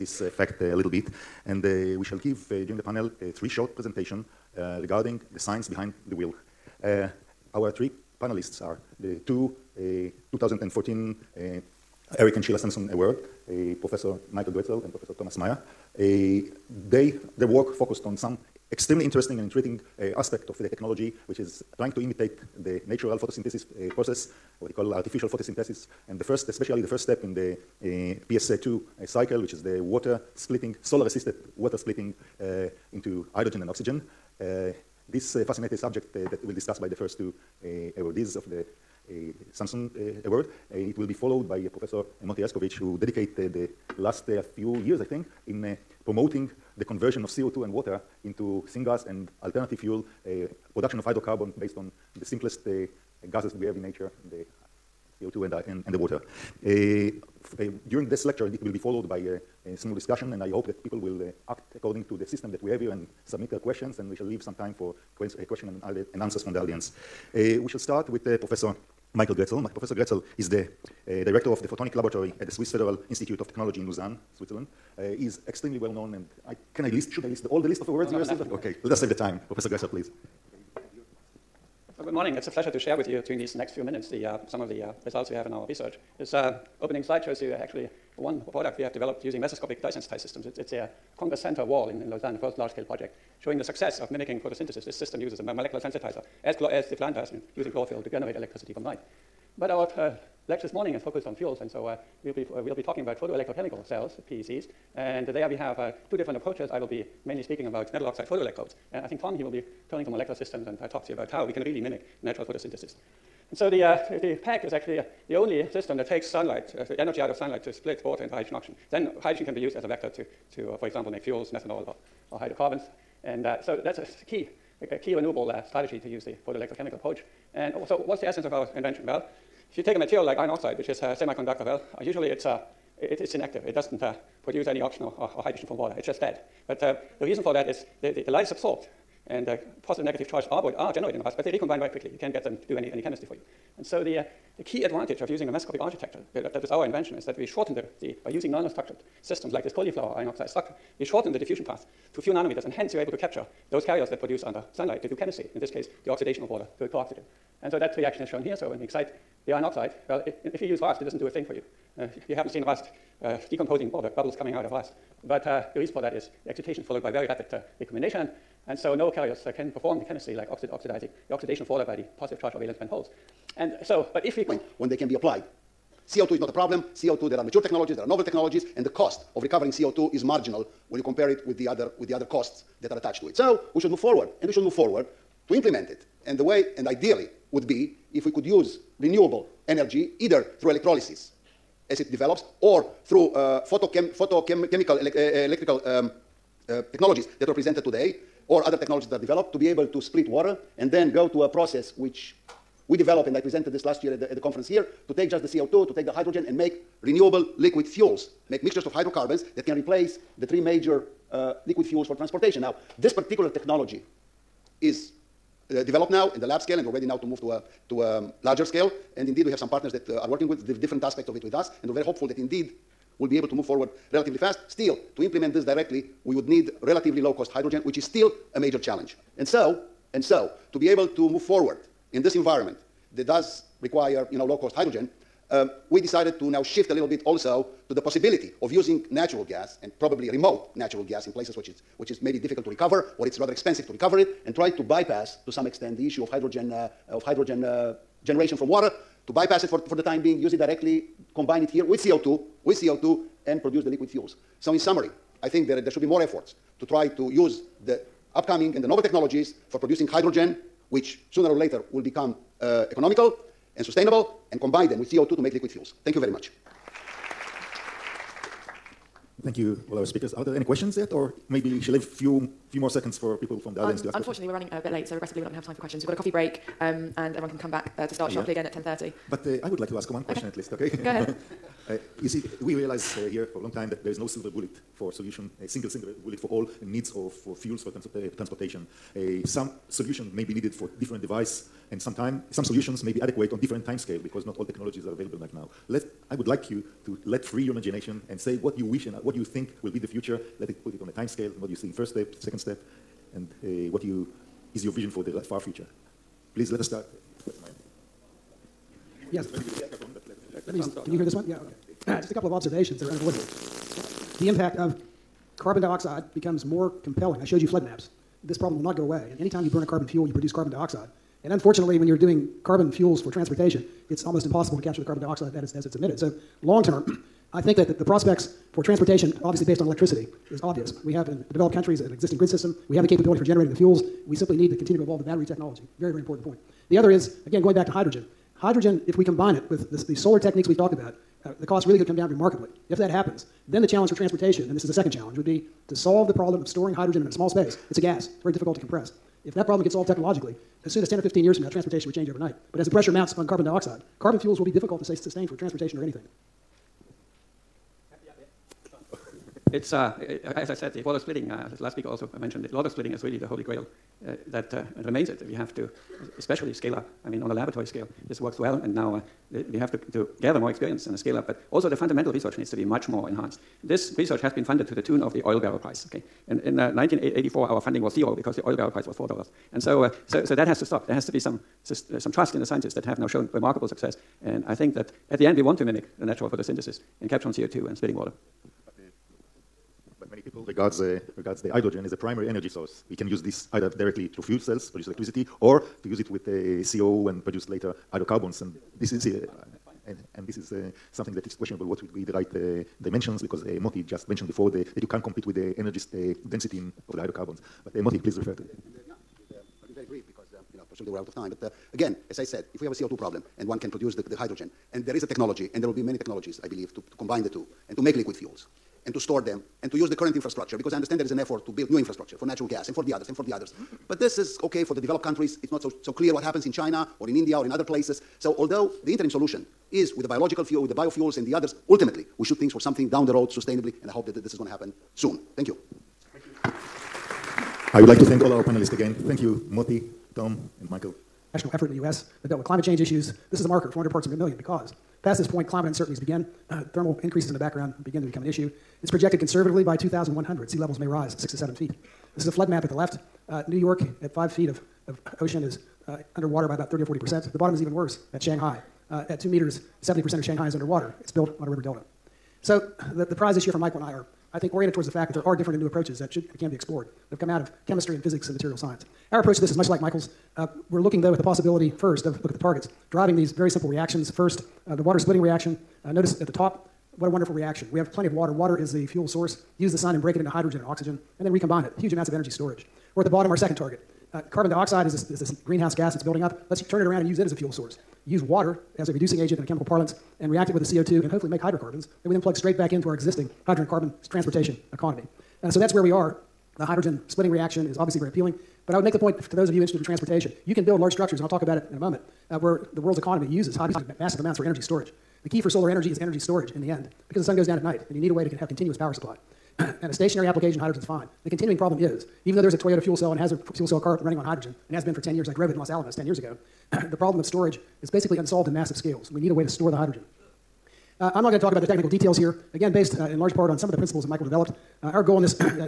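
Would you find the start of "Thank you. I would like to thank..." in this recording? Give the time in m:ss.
7:16.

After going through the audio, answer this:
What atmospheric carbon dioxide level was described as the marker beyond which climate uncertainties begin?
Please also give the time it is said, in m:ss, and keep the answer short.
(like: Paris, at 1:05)
400 parts per million, at 7:23.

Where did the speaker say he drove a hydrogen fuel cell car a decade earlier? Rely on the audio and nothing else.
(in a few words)
Los Alamos.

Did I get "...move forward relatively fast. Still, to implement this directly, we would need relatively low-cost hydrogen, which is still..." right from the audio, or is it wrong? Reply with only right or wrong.
right.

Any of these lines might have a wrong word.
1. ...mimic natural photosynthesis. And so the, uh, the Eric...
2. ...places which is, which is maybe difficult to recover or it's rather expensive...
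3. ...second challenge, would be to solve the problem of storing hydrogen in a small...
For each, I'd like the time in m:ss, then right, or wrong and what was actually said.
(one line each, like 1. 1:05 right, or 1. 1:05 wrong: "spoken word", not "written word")
1. 1:51 wrong: "PEC", not "Eric"
2. 4:01 right
3. 5:44 right.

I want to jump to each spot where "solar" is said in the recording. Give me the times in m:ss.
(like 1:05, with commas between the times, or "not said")
0:30, 5:40, 8:25.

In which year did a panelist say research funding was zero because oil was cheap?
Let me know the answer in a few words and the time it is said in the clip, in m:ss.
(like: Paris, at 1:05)
1984, at 6:16.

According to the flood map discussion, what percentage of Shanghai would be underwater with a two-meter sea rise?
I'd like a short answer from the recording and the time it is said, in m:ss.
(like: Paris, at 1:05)
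70 percent, at 7:40.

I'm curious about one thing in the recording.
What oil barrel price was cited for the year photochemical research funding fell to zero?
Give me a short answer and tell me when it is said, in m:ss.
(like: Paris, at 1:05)
four dollars, at 6:19.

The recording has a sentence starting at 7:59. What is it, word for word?
Use the sun and break it into hydrogen and oxygen, and then recombine it.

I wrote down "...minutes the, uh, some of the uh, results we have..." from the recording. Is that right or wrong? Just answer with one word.
right.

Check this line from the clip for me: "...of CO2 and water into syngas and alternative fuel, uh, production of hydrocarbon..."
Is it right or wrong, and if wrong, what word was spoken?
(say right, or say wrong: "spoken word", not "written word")
right.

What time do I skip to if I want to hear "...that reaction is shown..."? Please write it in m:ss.
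2:37.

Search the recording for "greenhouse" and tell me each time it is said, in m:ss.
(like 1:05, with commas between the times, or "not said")
8:05.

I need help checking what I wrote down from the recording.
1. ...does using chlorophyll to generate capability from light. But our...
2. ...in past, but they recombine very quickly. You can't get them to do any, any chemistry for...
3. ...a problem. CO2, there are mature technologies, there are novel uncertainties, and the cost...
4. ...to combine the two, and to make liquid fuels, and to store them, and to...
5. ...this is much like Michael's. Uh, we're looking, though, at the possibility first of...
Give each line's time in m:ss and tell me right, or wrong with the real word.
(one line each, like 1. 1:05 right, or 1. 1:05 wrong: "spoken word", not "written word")
1. 1:37 wrong: "electricity", not "capability"
2. 2:21 right
3. 2:56 wrong: "technologies", not "uncertainties"
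4. 6:56 right
5. 7:49 right.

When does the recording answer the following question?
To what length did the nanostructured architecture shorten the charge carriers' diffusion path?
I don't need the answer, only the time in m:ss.
2:32.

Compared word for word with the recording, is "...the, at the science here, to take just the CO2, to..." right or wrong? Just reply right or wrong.
wrong.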